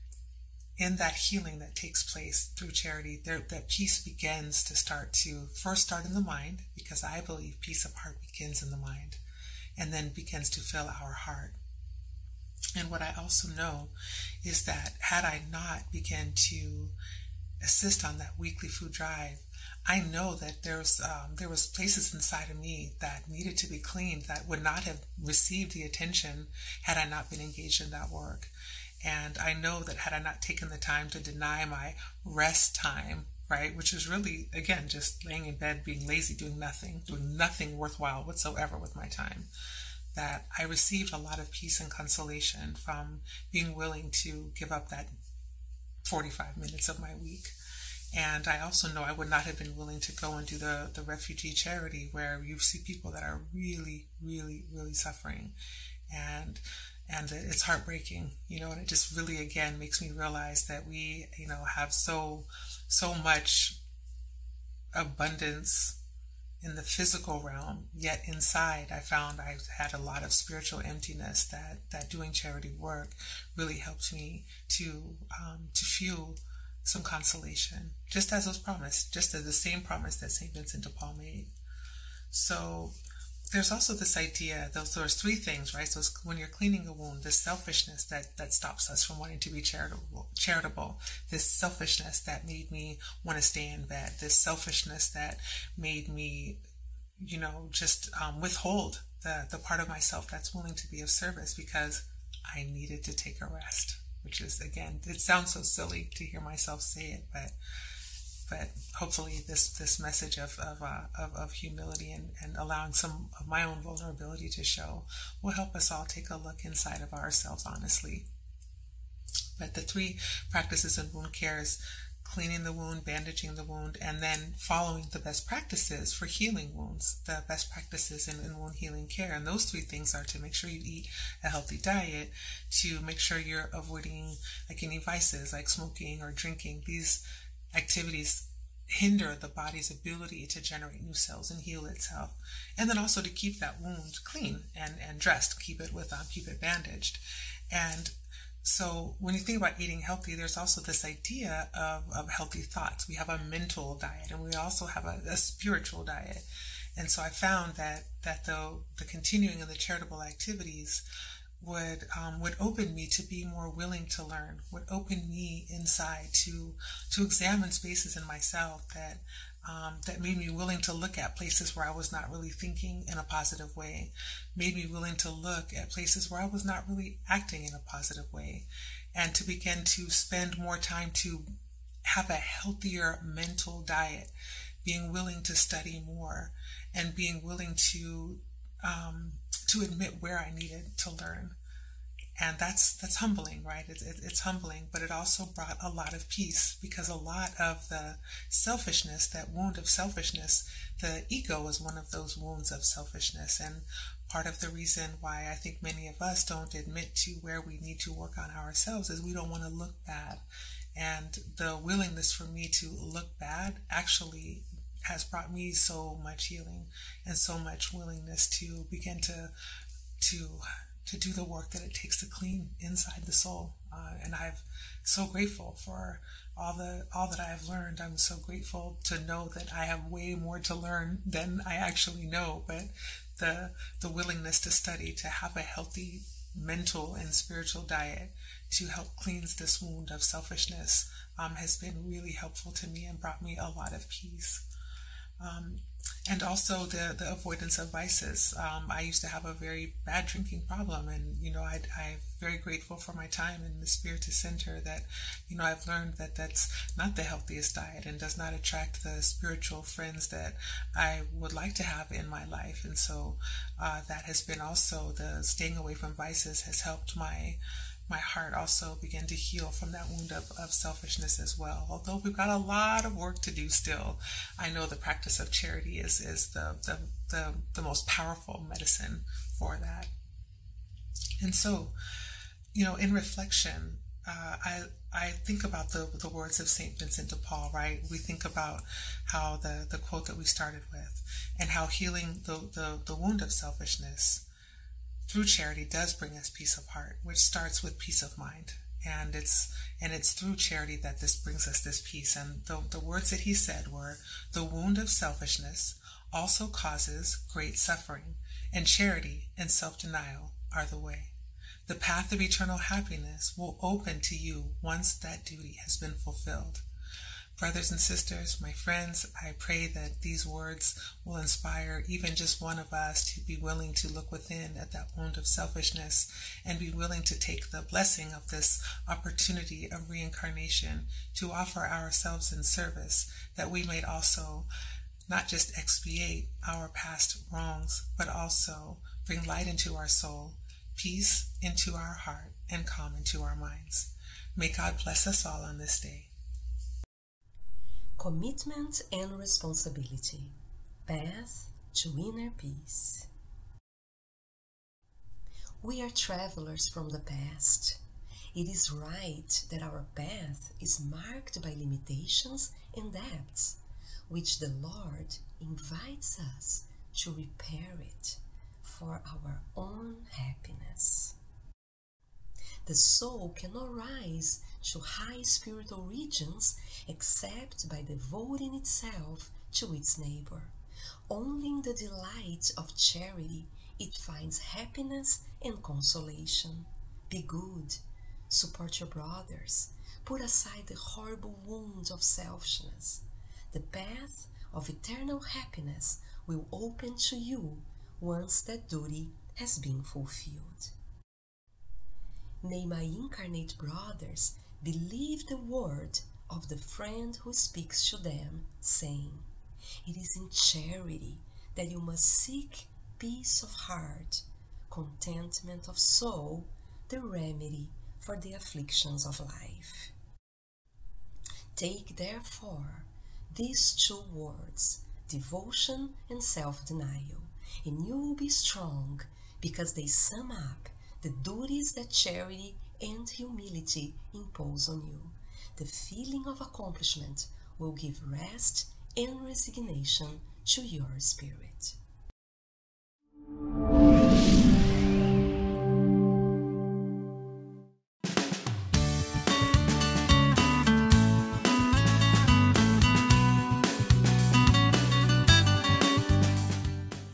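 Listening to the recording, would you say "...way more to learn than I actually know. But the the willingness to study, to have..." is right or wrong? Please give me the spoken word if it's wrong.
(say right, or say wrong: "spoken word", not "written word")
right.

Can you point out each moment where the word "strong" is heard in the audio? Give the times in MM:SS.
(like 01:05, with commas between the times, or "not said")
07:08.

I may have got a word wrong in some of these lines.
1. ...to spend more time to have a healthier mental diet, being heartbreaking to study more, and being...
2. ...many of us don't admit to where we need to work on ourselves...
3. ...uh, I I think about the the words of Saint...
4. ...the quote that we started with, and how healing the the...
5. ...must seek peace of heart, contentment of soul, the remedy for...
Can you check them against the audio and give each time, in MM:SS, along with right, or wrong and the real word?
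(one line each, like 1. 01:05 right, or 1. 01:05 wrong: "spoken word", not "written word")
1. 02:59 wrong: "willing", not "heartbreaking"
2. 03:25 right
3. 04:44 right
4. 04:49 right
5. 06:51 right.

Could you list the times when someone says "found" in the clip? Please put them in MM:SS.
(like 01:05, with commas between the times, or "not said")
01:08, 02:37.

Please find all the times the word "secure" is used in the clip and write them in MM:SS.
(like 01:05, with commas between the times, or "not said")
not said.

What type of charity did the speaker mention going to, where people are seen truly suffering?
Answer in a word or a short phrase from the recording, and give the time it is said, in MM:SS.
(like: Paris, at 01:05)
refugee charity, at 00:51.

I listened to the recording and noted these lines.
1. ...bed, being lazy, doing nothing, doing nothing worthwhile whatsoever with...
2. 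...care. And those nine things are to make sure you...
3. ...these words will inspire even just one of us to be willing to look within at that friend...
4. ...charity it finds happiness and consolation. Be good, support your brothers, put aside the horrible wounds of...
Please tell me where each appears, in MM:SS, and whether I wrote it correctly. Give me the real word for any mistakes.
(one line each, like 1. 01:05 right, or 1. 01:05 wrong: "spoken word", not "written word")
1. 00:35 right
2. 02:09 wrong: "three", not "nine"
3. 05:20 wrong: "wound", not "friend"
4. 06:22 right.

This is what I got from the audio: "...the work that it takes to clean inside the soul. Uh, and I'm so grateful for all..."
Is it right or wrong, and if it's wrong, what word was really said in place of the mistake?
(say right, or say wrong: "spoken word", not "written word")
right.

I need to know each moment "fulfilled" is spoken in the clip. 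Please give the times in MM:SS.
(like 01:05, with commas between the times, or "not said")
05:16, 06:40.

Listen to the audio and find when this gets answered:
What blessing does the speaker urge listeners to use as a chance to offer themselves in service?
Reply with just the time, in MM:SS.
05:30.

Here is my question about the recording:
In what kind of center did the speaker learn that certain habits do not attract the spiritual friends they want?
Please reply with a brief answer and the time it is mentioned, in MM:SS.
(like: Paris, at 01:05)
Spiritist Center, at 04:13.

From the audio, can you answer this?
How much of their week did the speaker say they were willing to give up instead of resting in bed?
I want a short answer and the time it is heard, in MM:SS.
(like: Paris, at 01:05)
45 minutes, at 00:46.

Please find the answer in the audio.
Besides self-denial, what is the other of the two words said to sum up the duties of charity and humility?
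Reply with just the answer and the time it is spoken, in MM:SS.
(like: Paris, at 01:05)
devotion, at 07:05.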